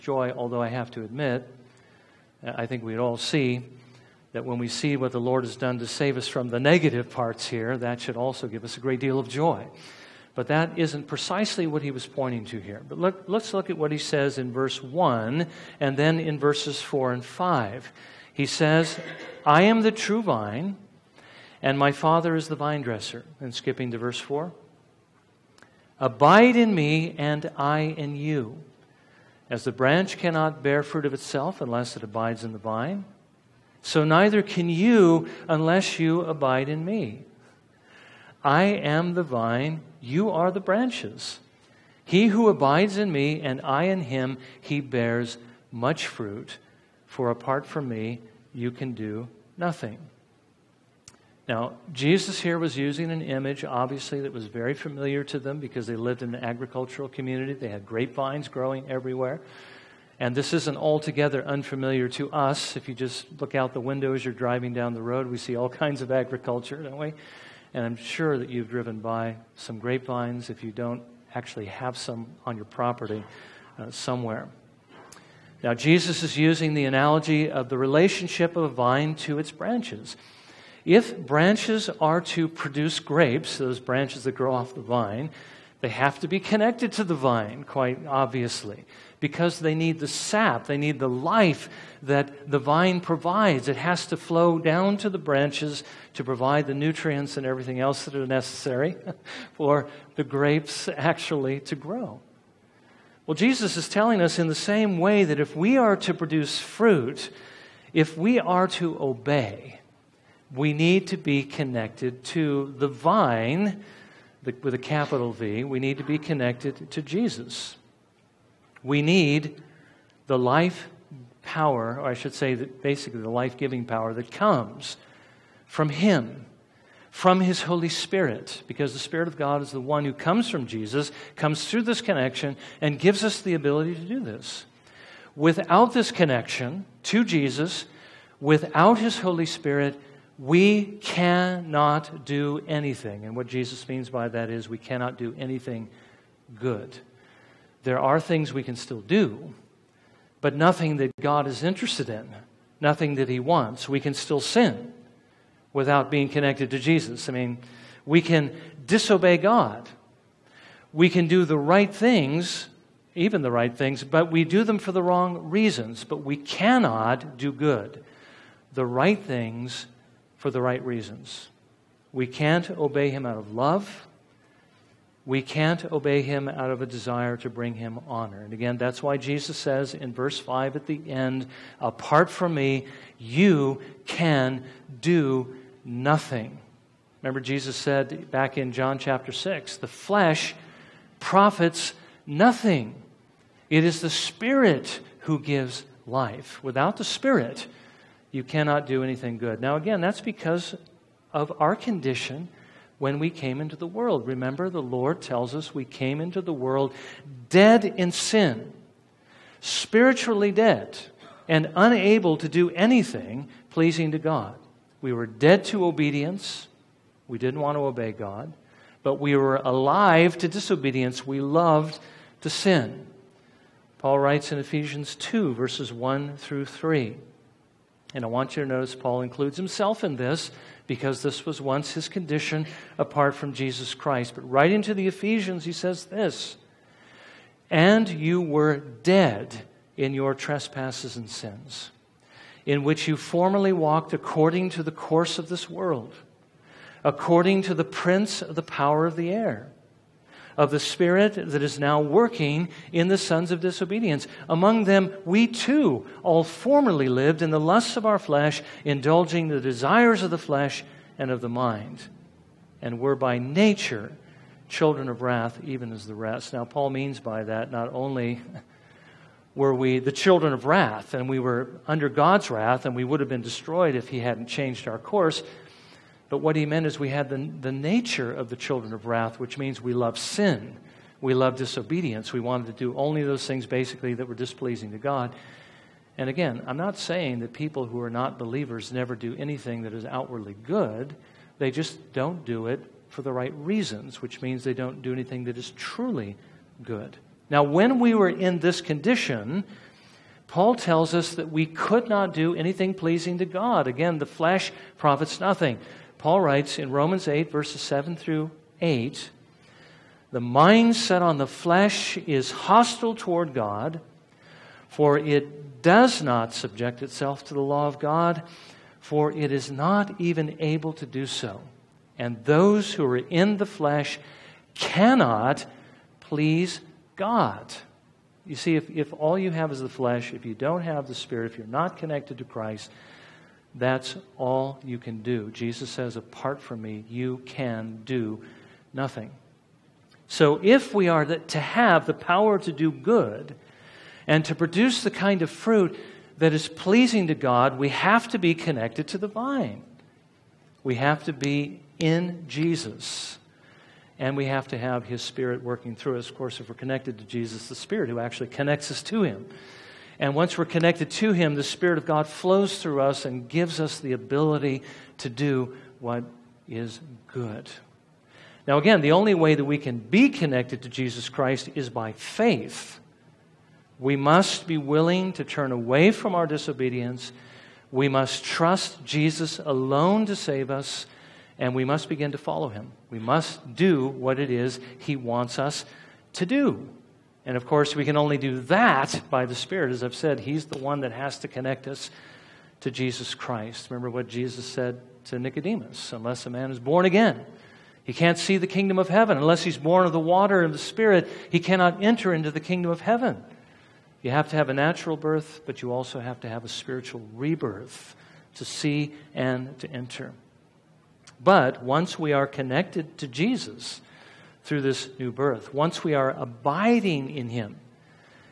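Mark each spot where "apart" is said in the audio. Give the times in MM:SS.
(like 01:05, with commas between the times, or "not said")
00:47, 03:01, 03:52, 05:36.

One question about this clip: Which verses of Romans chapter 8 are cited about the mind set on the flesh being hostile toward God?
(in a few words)
7 through 8.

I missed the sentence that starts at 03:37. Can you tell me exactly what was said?
We didn't want to obey God, but we were alive to disobedience.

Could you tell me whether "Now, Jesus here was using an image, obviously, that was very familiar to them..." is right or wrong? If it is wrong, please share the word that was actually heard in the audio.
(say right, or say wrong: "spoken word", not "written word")
right.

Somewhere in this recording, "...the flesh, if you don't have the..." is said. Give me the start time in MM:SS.
05:29.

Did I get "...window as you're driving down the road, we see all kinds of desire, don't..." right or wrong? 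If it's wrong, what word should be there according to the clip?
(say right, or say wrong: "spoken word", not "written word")
wrong: "agriculture", not "desire".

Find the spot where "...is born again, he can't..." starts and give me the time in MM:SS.
06:36.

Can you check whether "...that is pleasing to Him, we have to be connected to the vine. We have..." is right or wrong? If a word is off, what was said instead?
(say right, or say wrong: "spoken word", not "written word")
wrong: "God", not "Him".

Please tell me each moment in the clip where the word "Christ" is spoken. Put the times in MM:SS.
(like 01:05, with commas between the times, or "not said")
03:53, 05:32, 06:11, 06:33.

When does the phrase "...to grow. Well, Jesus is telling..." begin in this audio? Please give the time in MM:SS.
01:41.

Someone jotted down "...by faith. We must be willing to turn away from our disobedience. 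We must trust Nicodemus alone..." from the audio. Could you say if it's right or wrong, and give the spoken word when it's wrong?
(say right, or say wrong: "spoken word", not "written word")
wrong: "Jesus", not "Nicodemus".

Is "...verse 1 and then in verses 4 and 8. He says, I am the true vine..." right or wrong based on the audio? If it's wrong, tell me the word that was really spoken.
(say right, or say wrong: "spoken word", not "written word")
wrong: "5", not "8".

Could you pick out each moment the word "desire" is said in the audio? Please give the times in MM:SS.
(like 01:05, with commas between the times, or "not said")
02:56, 04:19.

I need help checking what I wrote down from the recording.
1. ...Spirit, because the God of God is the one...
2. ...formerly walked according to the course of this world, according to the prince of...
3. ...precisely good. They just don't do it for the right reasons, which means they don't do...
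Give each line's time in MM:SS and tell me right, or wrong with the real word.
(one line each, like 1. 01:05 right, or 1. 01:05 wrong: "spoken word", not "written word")
1. 02:07 wrong: "Spirit", not "God"
2. 04:03 right
3. 04:50 wrong: "outwardly", not "precisely".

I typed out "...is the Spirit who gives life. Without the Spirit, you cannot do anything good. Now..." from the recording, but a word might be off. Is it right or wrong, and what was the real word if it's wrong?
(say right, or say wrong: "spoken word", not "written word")
right.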